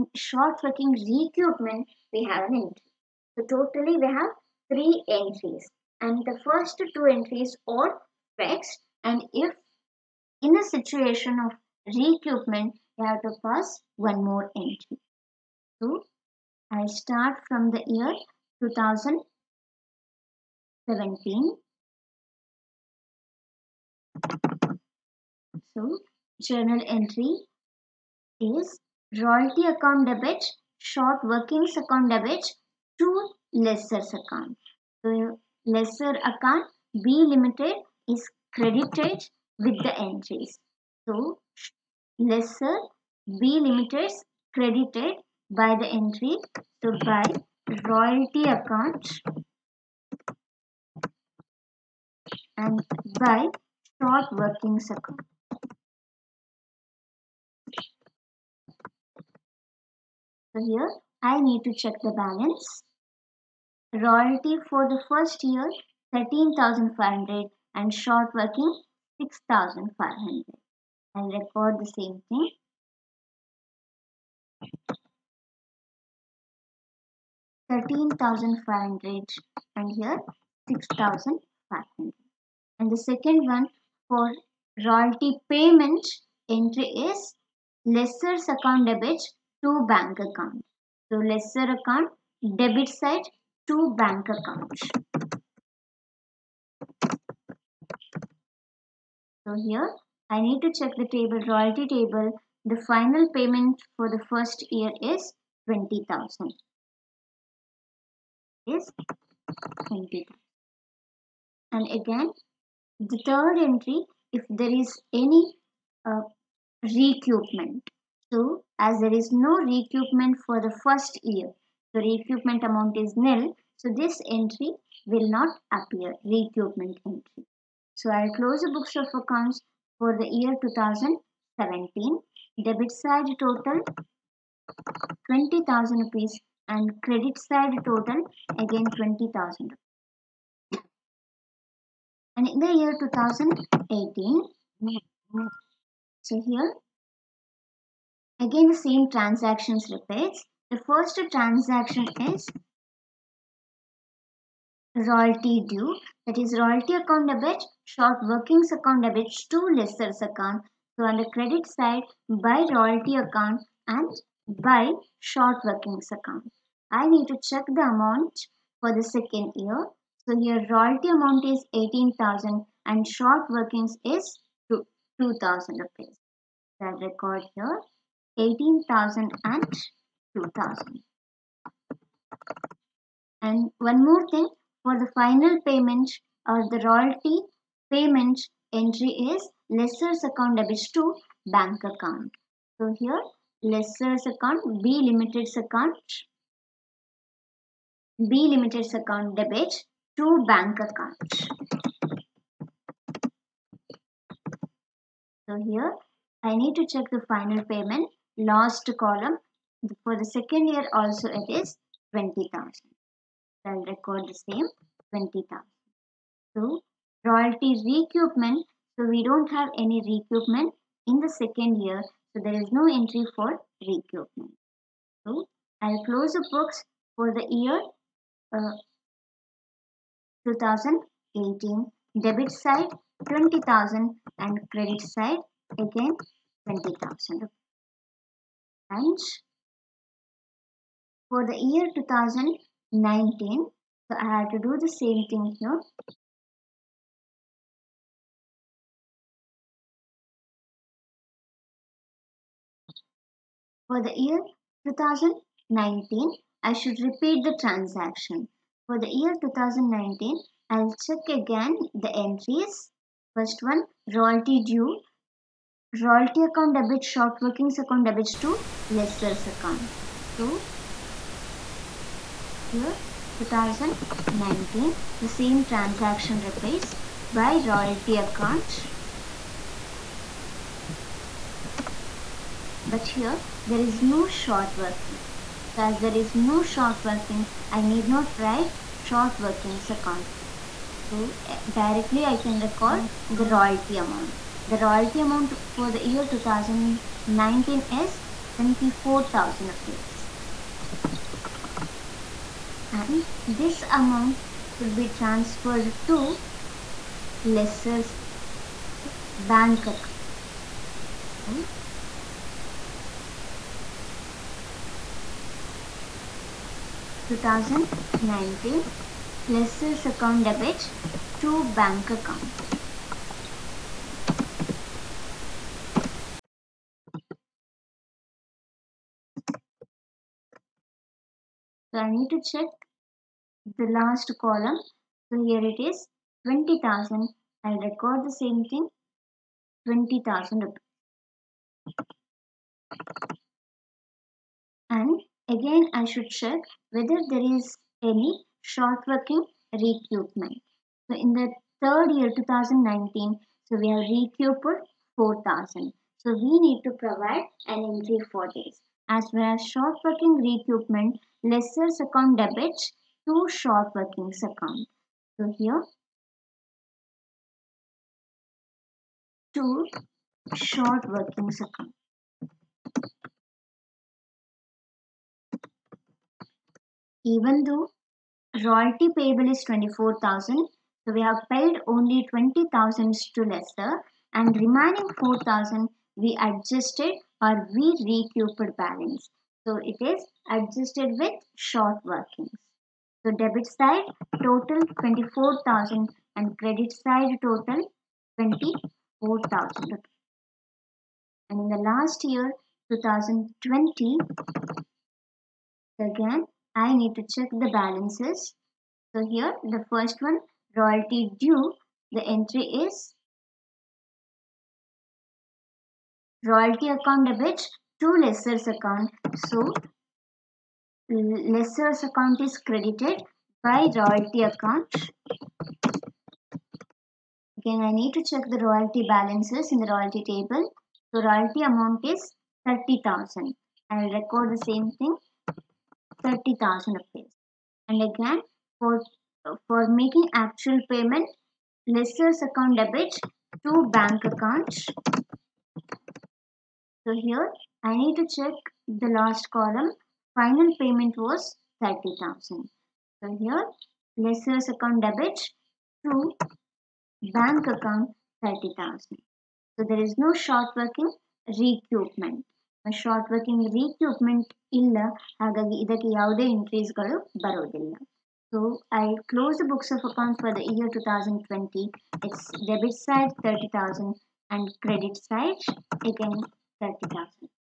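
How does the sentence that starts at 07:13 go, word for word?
I will record the same thing, 30,000 appears.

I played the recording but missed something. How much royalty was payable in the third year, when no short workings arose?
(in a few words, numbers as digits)
24,000.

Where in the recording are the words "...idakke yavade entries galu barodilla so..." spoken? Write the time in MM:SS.
07:45.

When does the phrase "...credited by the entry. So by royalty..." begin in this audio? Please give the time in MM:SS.
00:44.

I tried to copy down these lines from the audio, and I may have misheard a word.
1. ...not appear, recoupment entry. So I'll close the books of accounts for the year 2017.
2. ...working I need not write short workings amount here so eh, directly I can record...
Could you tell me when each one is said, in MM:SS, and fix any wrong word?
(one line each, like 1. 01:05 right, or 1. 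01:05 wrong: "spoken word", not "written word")
1. 02:05 right
2. 04:47 wrong: "account", not "amount".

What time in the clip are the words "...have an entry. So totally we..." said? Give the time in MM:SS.
00:02.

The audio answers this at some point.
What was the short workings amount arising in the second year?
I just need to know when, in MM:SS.
02:54.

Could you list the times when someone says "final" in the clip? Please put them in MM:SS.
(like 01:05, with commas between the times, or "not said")
01:42, 03:05, 03:27, 07:30.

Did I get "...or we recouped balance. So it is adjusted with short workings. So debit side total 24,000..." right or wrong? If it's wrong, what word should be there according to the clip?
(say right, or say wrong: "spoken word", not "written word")
right.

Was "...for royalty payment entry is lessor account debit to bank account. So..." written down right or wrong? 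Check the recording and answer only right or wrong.
right.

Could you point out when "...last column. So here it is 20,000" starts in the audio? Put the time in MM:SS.
05:33.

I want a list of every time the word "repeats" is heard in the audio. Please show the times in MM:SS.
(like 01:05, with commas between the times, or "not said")
02:29, 04:17.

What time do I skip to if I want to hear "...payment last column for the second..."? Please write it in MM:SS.
03:27.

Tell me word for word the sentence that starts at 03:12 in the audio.
So here lessor's account, B limited's account, B limited's account debit to bank account.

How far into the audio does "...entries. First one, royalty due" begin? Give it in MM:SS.
04:22.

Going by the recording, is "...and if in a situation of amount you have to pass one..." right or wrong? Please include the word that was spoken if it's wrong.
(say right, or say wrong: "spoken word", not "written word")
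wrong: "recoupment", not "amount".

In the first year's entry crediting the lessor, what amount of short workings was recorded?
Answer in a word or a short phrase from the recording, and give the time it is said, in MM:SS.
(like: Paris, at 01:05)
6,500, at 01:20.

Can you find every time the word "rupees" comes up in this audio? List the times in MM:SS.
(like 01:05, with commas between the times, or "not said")
02:15, 02:55, 04:59, 05:40.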